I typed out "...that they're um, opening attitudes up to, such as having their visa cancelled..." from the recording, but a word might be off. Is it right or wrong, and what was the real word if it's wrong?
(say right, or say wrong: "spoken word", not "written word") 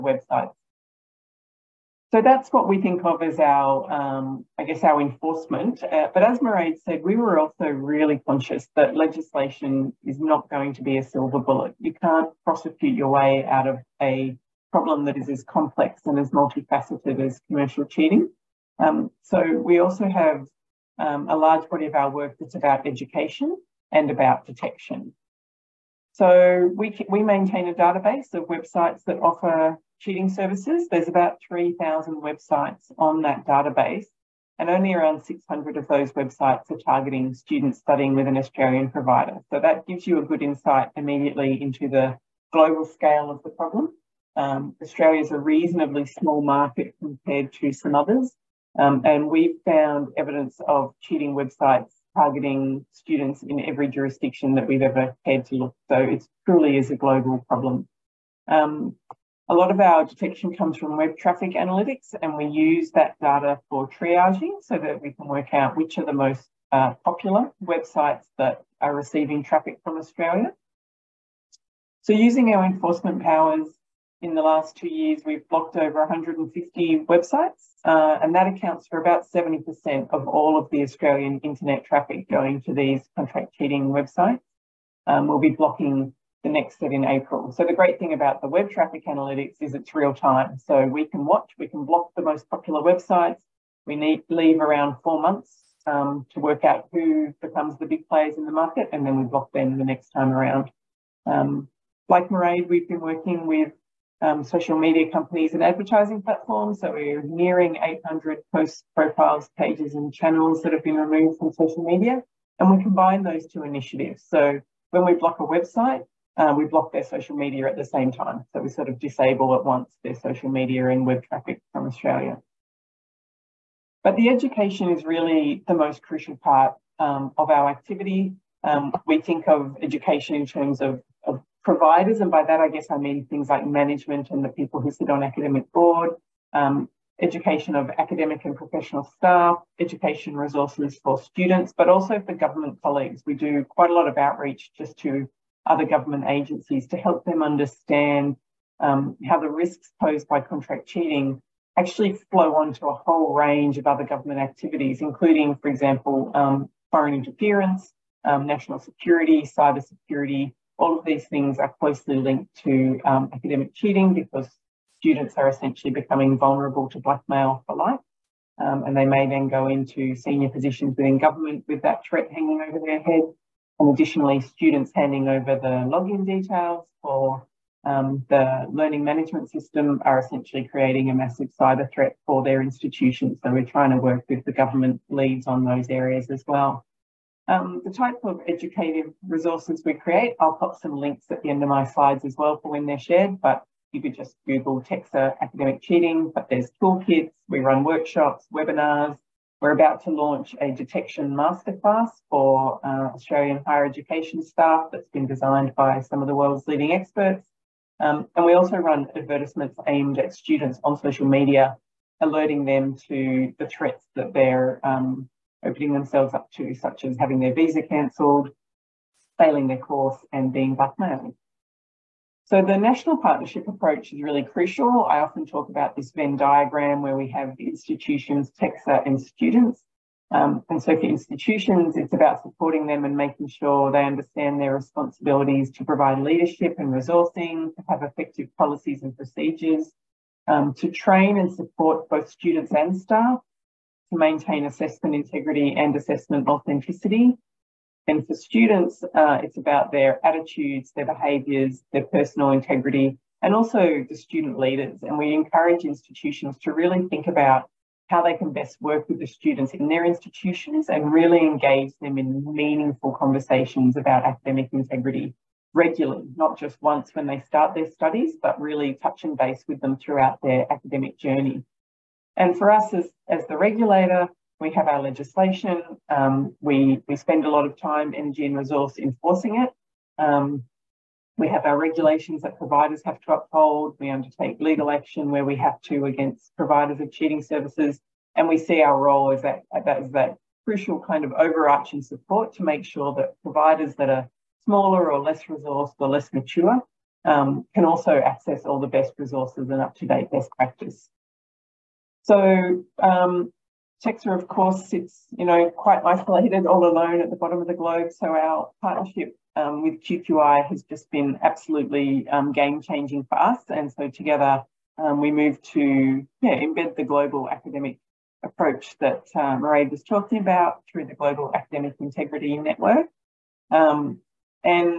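wrong: "themselves", not "attitudes".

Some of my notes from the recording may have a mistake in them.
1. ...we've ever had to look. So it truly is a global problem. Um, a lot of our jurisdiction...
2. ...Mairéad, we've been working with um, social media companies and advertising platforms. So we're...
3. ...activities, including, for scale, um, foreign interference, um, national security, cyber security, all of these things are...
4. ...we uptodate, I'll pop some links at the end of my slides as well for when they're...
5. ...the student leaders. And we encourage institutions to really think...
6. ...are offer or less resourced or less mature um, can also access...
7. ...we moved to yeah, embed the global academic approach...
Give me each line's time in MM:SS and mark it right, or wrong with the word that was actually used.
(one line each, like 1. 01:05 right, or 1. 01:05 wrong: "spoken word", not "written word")
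1. 00:54 wrong: "detection", not "jurisdiction"
2. 01:42 right
3. 02:34 wrong: "example", not "scale"
4. 03:09 wrong: "create", not "uptodate"
5. 04:14 right
6. 04:54 wrong: "smaller", not "offer"
7. 05:15 right.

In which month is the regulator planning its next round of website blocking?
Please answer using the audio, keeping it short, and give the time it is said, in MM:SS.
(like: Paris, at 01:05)
April, at 01:27.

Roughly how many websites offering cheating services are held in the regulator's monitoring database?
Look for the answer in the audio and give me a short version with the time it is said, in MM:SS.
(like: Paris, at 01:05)
3,000, at 00:31.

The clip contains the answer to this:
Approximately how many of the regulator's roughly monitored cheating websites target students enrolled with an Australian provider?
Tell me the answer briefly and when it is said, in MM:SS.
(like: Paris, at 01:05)
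600, at 00:34.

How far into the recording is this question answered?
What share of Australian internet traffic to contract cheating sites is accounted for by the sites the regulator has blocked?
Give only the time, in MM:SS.
01:19.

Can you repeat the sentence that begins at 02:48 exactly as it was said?
Um, and they may then go into senior positions within government with that threat hanging over their head.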